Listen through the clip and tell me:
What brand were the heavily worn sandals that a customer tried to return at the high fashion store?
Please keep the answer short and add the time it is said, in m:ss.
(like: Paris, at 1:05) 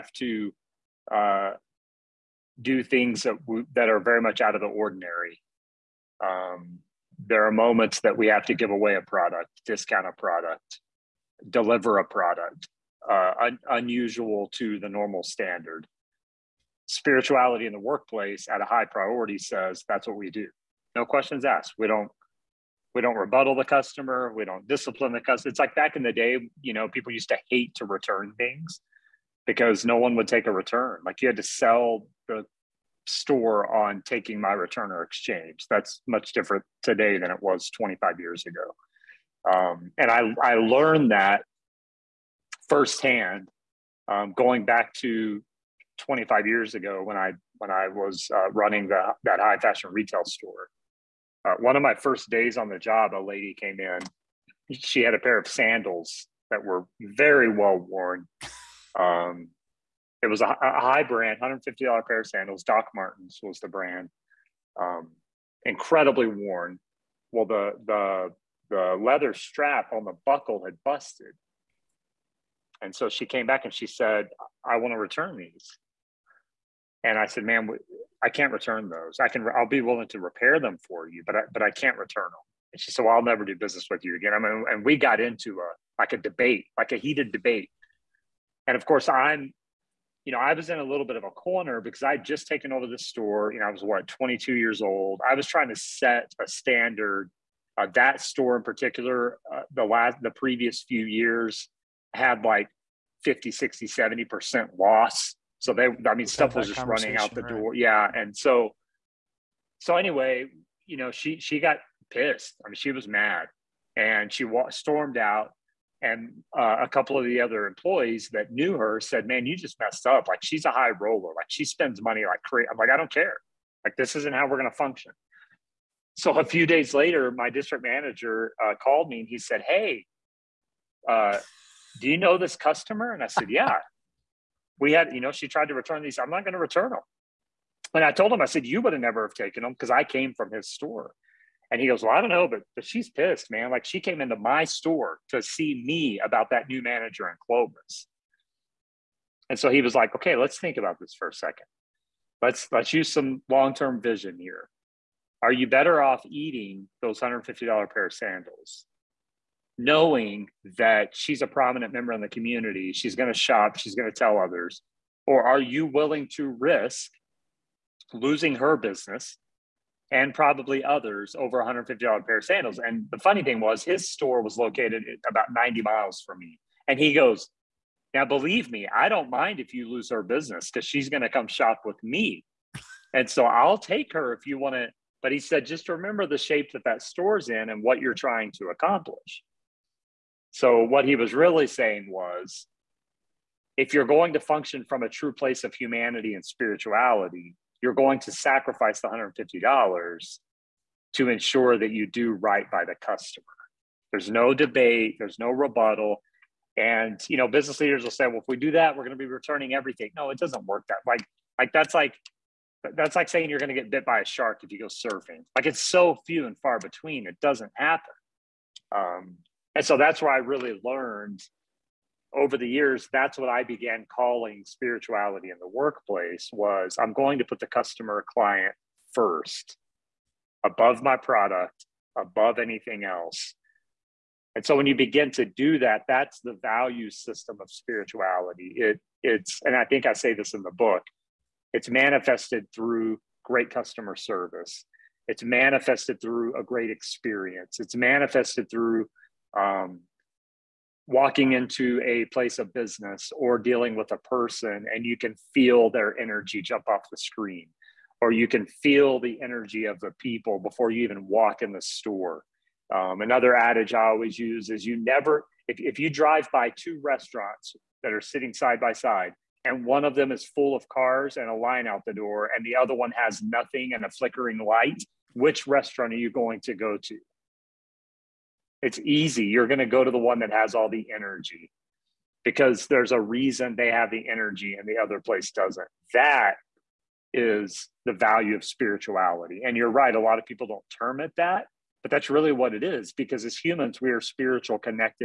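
Doc Martens, at 1:02.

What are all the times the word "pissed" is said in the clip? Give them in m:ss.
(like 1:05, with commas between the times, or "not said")
1:52, 2:23.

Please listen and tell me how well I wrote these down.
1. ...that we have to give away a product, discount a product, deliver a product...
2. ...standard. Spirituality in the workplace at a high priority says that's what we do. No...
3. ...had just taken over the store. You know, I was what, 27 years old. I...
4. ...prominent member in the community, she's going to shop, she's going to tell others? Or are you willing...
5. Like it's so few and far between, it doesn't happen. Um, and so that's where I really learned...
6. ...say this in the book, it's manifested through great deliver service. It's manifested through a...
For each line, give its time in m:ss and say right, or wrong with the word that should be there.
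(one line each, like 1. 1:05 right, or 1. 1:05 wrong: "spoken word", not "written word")
1. 0:08 right
2. 0:15 right
3. 1:32 wrong: "22", not "27"
4. 2:41 right
5. 3:35 right
6. 4:00 wrong: "customer", not "deliver".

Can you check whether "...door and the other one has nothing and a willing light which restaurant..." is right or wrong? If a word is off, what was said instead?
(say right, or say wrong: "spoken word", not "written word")
wrong: "flickering", not "willing".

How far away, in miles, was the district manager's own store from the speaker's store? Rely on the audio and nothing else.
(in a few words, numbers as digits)
90 miles.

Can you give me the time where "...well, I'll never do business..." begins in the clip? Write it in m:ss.
1:23.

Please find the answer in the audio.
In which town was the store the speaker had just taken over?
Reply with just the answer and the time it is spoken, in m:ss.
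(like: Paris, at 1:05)
Clovis, at 2:27.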